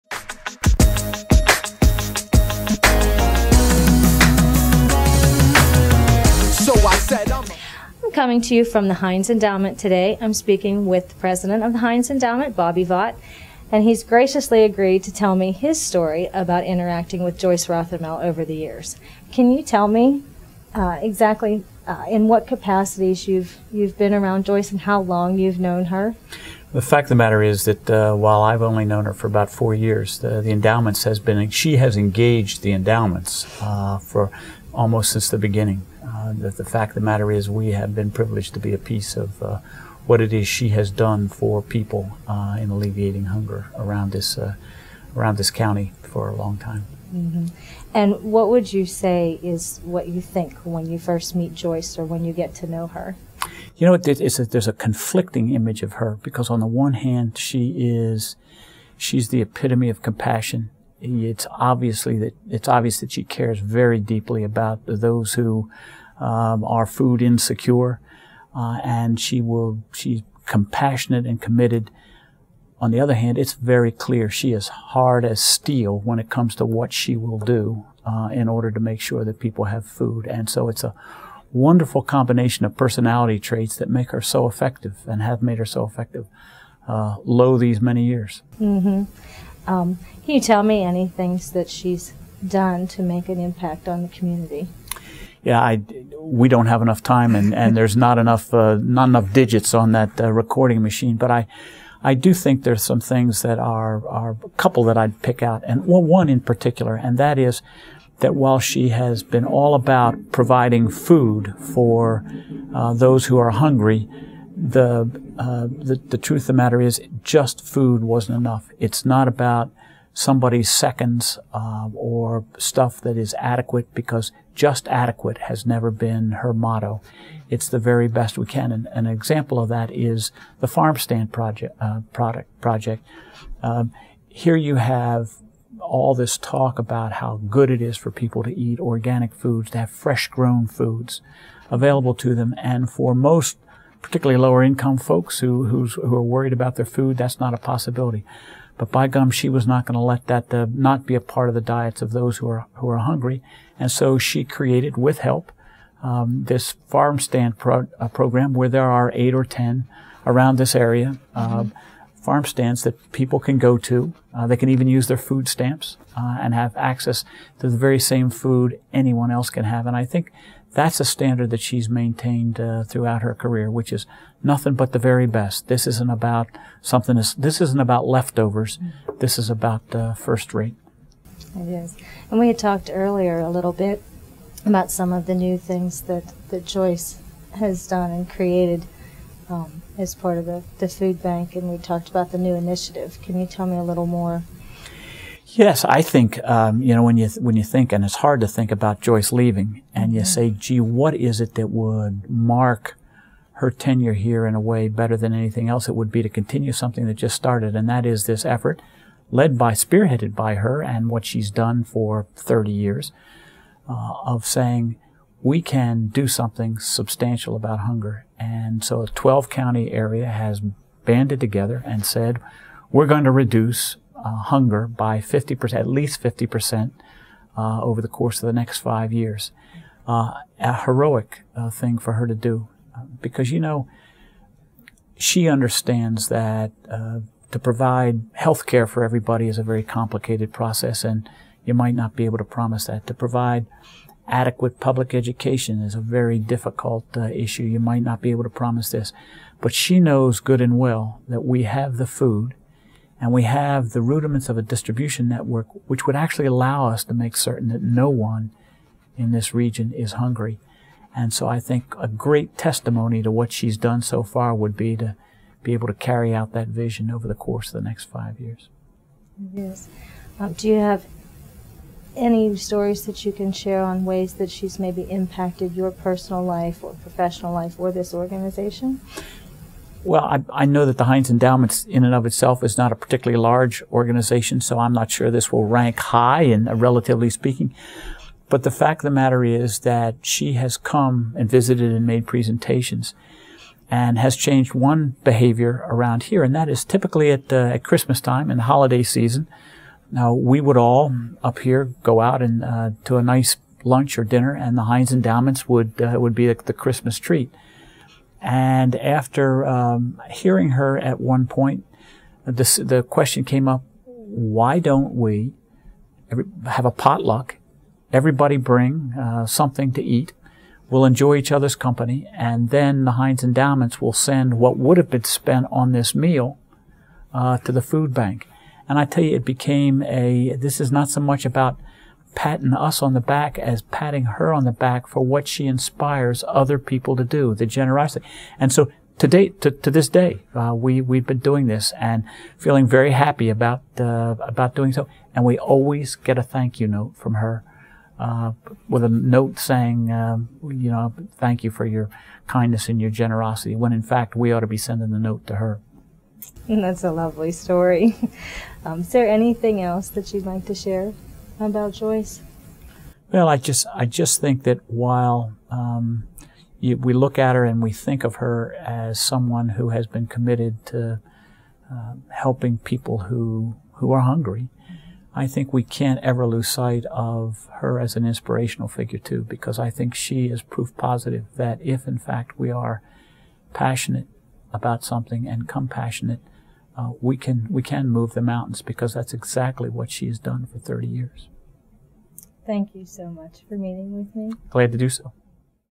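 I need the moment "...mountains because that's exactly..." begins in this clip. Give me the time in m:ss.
6:28.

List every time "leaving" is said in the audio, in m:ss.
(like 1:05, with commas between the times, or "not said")
3:19.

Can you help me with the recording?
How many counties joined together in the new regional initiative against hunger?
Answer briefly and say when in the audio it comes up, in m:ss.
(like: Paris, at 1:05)
12, at 3:39.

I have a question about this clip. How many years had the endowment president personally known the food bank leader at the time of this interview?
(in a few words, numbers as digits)
4 years.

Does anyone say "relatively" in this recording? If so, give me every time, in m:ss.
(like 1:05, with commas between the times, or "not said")
4:46.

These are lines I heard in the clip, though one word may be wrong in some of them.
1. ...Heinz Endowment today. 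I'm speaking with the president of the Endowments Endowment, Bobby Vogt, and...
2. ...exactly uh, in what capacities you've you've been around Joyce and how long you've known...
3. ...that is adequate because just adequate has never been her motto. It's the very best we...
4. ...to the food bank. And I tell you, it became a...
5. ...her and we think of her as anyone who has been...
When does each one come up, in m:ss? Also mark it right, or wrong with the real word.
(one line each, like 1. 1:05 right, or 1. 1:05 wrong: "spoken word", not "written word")
1. 0:08 wrong: "Heinz", not "Endowments"
2. 0:21 right
3. 2:03 right
4. 5:27 right
5. 6:07 wrong: "someone", not "anyone".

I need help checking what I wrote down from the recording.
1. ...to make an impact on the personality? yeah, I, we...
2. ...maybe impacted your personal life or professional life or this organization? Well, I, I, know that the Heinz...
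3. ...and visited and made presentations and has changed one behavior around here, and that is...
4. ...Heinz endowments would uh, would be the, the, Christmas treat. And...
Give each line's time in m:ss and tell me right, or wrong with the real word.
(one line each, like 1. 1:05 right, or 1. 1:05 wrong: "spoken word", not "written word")
1. 1:32 wrong: "community", not "personality"
2. 4:34 right
3. 4:51 right
4. 5:04 right.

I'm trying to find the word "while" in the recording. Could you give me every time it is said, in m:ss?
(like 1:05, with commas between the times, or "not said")
0:28, 1:48, 6:04.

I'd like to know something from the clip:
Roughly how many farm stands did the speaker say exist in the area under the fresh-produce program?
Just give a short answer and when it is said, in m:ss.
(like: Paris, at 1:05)
8 or 10, at 2:39.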